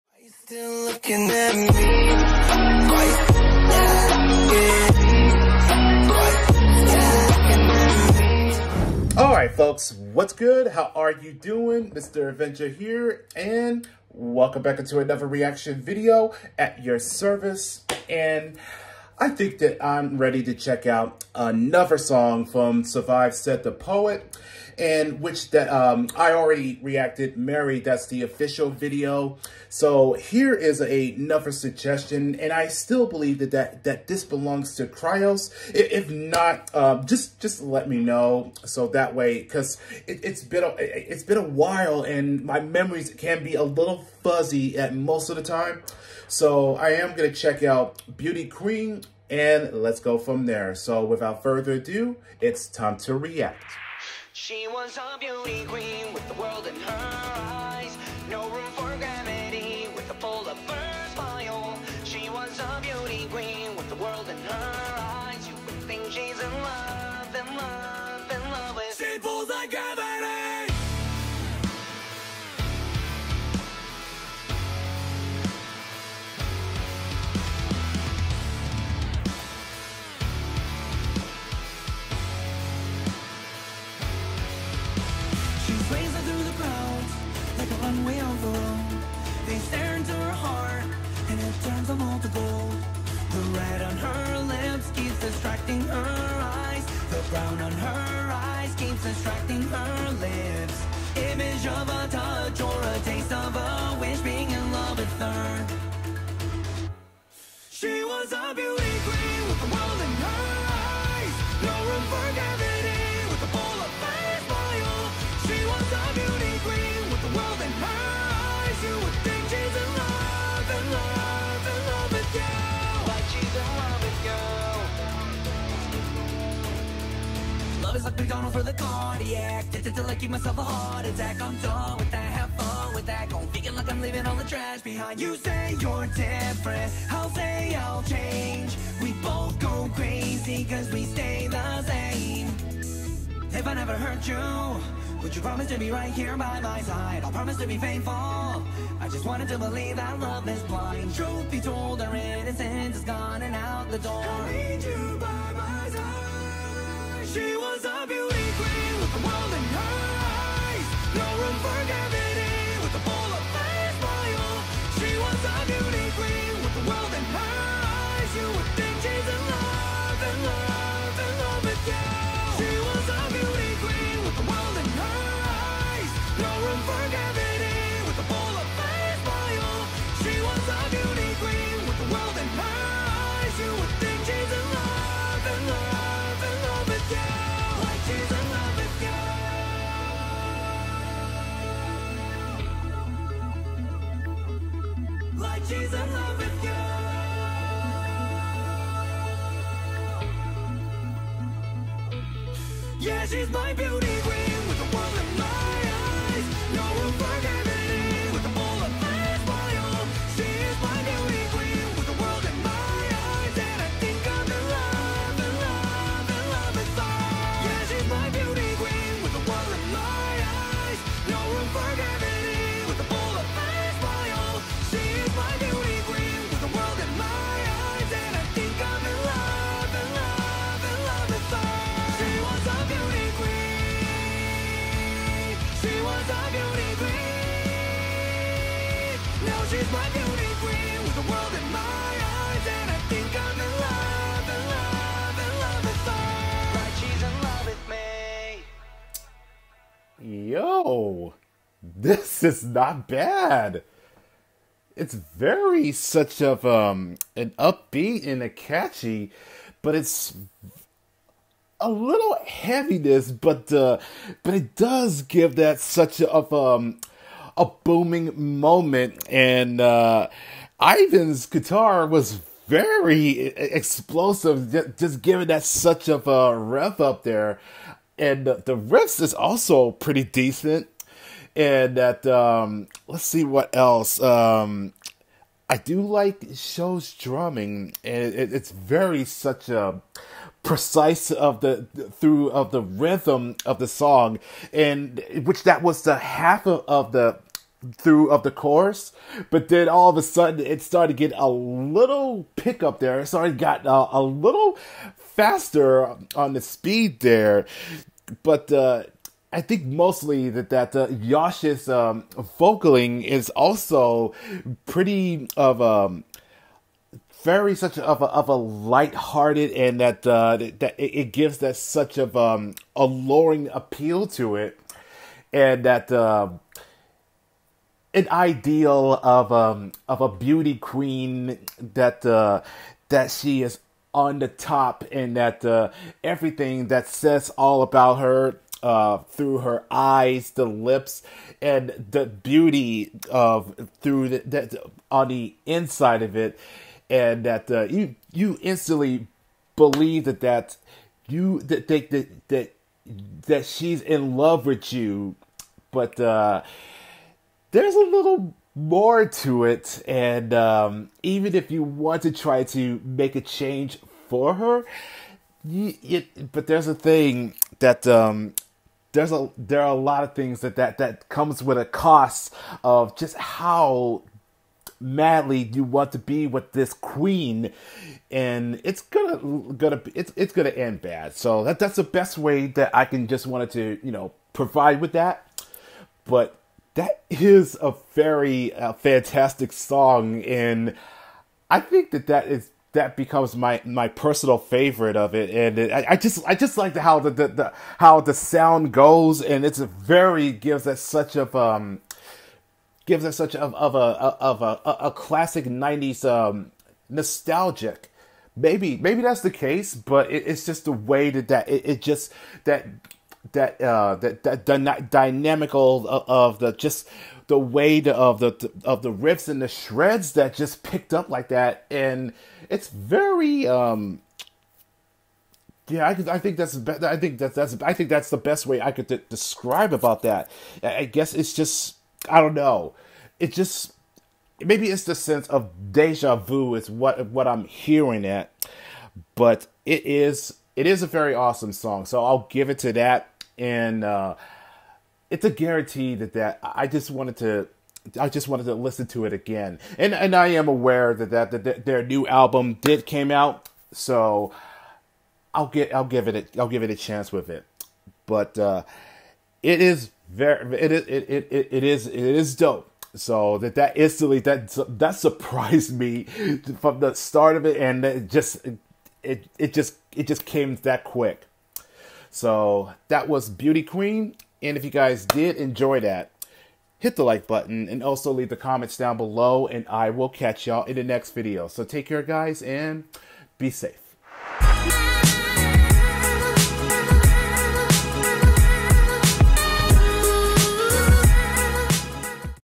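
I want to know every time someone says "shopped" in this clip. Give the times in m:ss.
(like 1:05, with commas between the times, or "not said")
not said.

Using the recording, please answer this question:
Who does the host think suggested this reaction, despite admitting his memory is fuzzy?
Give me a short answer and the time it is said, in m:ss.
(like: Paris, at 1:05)
Cryos, at 0:34.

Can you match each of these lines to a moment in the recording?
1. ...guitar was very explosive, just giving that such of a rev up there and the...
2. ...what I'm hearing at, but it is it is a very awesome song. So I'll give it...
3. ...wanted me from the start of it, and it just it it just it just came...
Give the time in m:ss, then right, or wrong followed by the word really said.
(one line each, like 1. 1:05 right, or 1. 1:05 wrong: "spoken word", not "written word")
1. 4:31 right
2. 7:17 right
3. 7:45 wrong: "surprised", not "wanted".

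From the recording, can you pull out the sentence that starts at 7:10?
I guess it's just I don't know.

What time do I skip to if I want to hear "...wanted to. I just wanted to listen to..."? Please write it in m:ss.
7:27.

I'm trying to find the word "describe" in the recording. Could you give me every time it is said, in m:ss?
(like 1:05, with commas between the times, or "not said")
7:09.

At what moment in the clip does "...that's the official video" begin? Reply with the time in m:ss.
0:27.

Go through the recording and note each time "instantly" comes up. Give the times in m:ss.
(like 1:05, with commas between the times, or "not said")
5:48, 7:43.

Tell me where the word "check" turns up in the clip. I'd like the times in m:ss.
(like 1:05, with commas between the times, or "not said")
0:20, 0:47.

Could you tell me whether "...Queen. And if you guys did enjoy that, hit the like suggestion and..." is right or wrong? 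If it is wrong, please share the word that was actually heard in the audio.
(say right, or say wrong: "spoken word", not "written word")
wrong: "button", not "suggestion".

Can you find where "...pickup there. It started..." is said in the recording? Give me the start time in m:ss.
5:02.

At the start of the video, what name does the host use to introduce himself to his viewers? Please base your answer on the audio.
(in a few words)
Mighty Avenger.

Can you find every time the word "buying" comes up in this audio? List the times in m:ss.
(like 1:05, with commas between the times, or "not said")
not said.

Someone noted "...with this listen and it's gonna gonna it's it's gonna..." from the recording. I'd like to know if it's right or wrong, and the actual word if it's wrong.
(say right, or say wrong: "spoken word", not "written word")
wrong: "queen", not "listen".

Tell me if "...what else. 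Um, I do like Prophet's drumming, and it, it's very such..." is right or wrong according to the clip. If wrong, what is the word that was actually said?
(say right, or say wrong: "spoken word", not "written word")
wrong: "Show", not "Prophet".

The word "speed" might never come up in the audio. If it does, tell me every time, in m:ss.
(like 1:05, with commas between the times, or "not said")
5:06.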